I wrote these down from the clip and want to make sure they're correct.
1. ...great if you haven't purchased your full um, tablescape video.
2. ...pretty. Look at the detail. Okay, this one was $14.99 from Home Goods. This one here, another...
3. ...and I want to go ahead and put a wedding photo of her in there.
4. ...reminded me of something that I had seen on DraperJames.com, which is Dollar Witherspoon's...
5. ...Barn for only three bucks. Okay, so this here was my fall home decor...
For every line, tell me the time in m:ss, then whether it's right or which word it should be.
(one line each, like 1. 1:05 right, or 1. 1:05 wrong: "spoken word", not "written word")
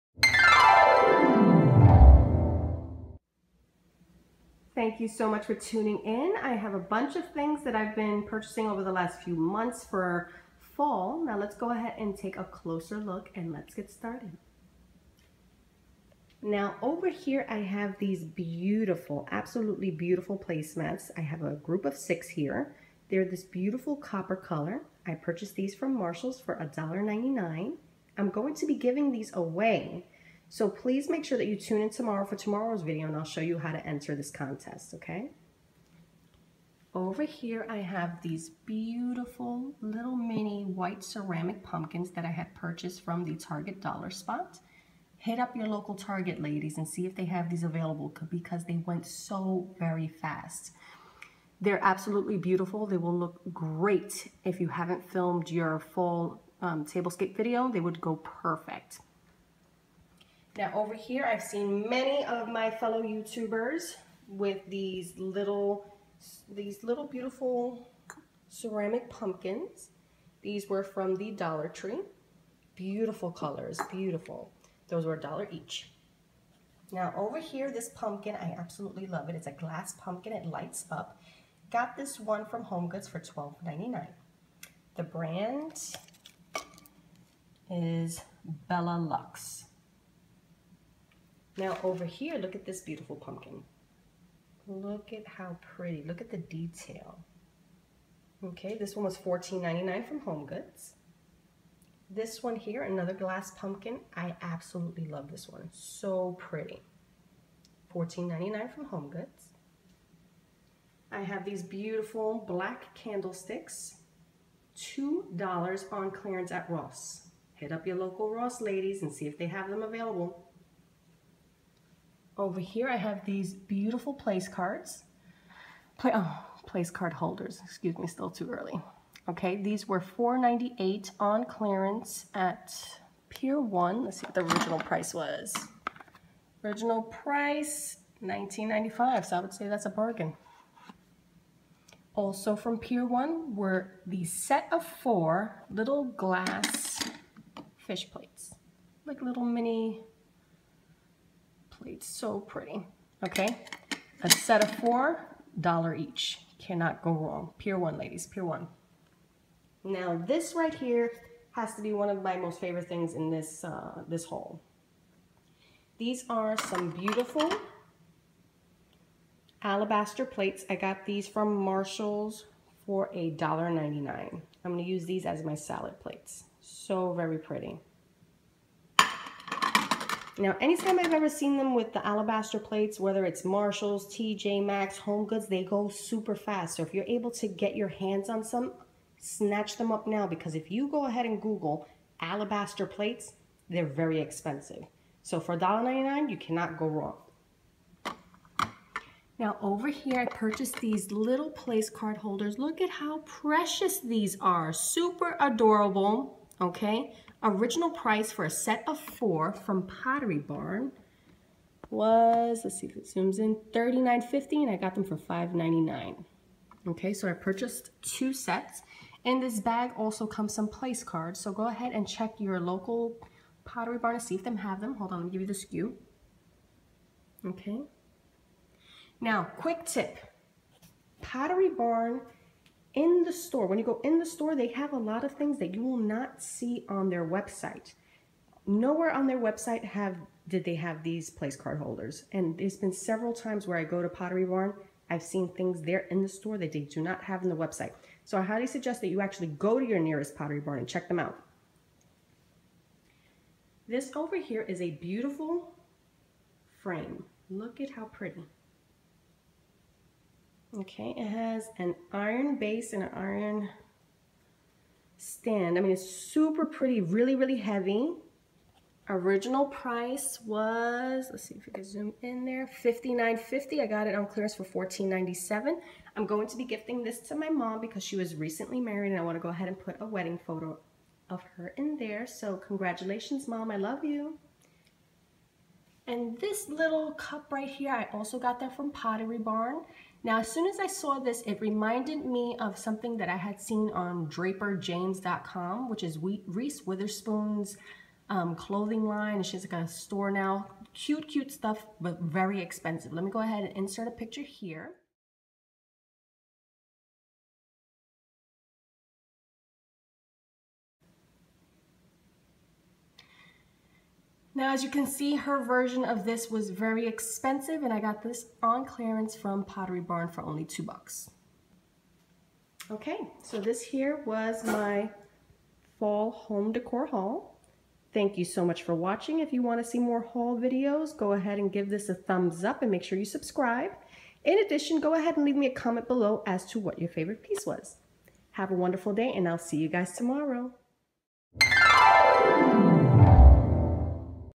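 1. 0:53 wrong: "filmed", not "purchased"
2. 1:35 right
3. 4:39 right
4. 4:51 wrong: "Reese", not "Dollar"
5. 5:20 wrong: "two", not "three".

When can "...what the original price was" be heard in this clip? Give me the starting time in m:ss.
2:14.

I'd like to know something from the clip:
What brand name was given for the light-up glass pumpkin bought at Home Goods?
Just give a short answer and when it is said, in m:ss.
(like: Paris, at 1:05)
Bella Lux, at 1:28.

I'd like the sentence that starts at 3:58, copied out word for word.
Nowhere on their website have did they have these place card holders.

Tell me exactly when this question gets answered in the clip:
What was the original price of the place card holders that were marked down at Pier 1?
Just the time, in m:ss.
2:18.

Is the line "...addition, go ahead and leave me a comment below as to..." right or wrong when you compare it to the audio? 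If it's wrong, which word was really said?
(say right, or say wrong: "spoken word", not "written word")
right.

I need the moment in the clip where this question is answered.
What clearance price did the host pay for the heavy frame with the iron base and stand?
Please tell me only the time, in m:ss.
4:34.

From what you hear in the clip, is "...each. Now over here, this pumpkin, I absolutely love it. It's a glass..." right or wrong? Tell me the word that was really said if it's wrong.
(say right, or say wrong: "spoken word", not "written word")
right.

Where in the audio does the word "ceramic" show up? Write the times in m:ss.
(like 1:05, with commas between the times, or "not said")
0:41, 1:08.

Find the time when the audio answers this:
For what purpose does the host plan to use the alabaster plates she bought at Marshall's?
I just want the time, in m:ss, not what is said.
2:55.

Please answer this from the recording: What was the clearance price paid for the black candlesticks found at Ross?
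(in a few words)
$2.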